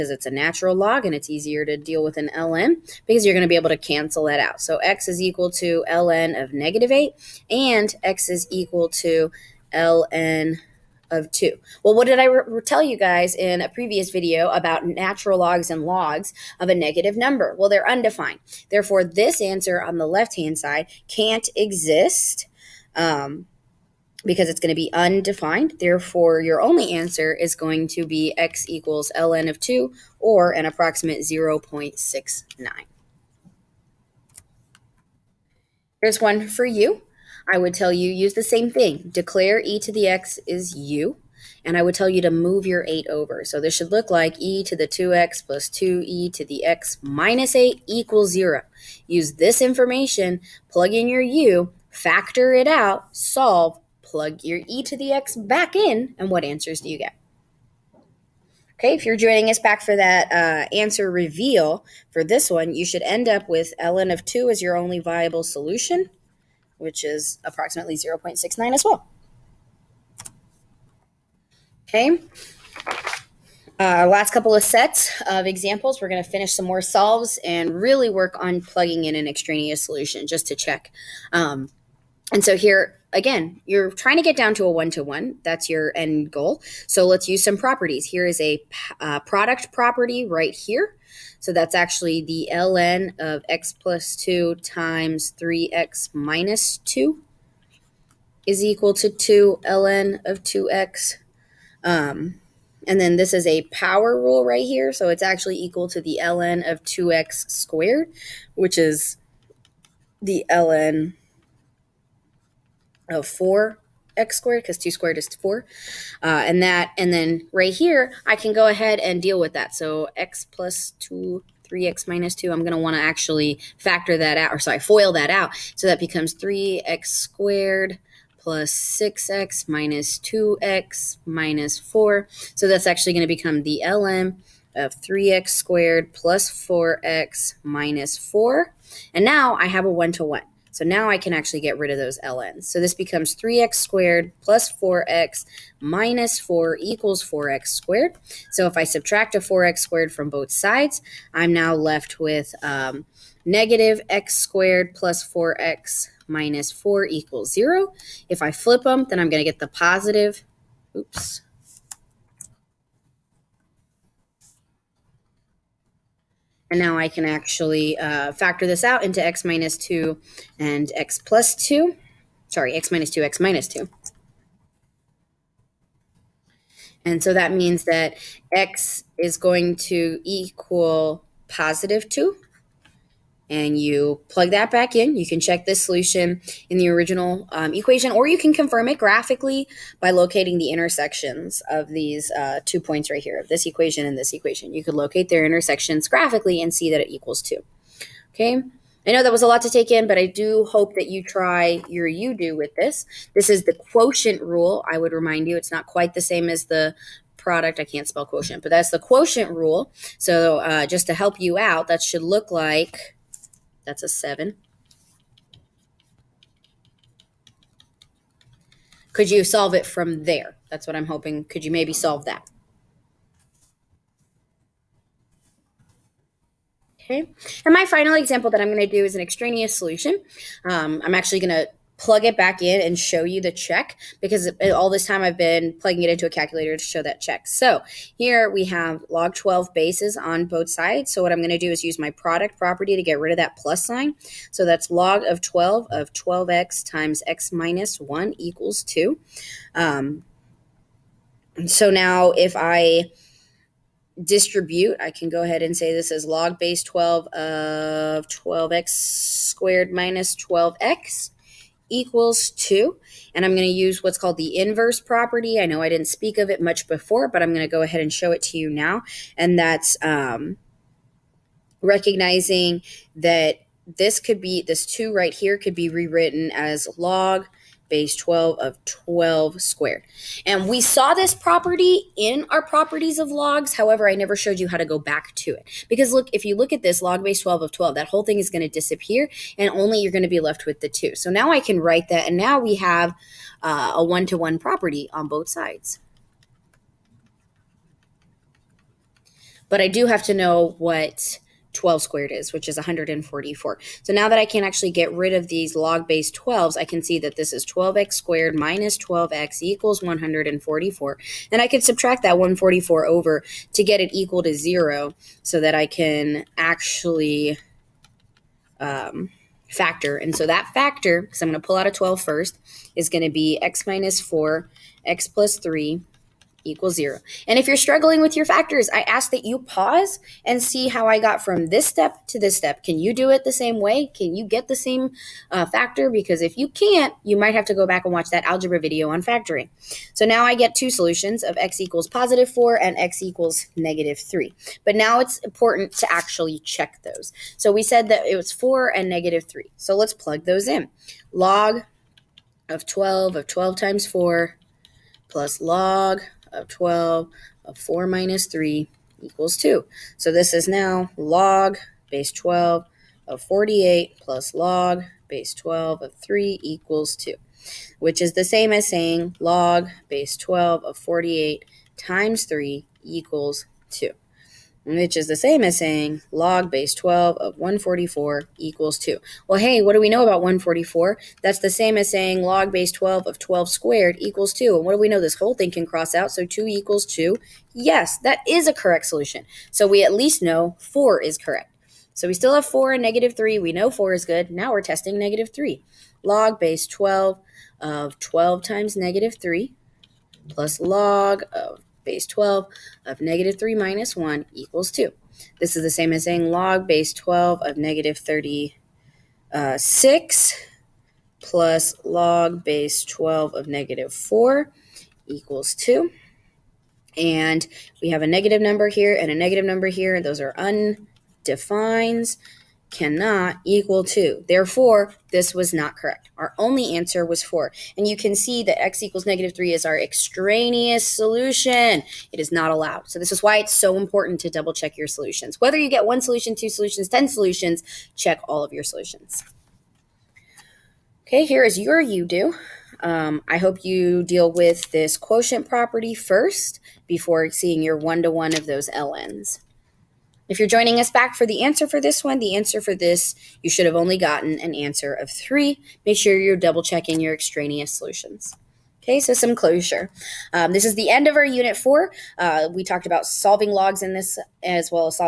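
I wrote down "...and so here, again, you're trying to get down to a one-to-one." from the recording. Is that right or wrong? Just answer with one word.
right.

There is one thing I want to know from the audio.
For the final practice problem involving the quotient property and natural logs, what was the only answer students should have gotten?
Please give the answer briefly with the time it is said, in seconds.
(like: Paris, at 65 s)
3, at 455 s.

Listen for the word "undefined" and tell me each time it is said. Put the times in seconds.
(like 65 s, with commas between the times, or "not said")
17 s, 24 s, 420 s.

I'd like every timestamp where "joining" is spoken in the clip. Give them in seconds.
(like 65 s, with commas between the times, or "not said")
59 s, 450 s.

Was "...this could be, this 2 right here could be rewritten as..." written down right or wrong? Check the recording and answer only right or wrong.
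right.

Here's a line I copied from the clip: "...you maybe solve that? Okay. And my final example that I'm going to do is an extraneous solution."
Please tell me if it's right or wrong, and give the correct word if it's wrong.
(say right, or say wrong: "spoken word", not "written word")
right.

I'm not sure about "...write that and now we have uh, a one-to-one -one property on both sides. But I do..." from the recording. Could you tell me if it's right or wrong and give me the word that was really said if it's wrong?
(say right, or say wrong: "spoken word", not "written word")
right.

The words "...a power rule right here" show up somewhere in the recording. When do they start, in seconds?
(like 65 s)
103 s.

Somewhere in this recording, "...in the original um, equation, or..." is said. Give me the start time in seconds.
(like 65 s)
186 s.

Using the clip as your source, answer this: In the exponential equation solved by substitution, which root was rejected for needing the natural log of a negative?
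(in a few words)
ln of -8.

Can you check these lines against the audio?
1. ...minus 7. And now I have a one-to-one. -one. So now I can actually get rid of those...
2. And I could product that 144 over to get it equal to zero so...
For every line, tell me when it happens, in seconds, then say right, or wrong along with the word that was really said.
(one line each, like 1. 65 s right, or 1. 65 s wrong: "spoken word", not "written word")
1. 137 s wrong: "4", not "7"
2. 311 s wrong: "subtract", not "product".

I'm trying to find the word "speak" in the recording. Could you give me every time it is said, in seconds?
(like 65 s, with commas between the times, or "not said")
266 s.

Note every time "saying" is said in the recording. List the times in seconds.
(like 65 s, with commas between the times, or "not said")
368 s, 375 s, 382 s, 406 s.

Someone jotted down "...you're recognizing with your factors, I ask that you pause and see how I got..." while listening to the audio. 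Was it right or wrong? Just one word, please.
wrong.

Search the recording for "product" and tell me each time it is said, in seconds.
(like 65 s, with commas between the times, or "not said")
89 s, 207 s, 242 s.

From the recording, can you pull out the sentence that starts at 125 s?
So that becomes 3x squared plus 6x minus 2x minus 4.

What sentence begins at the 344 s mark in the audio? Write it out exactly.
But now it's important to actually check those.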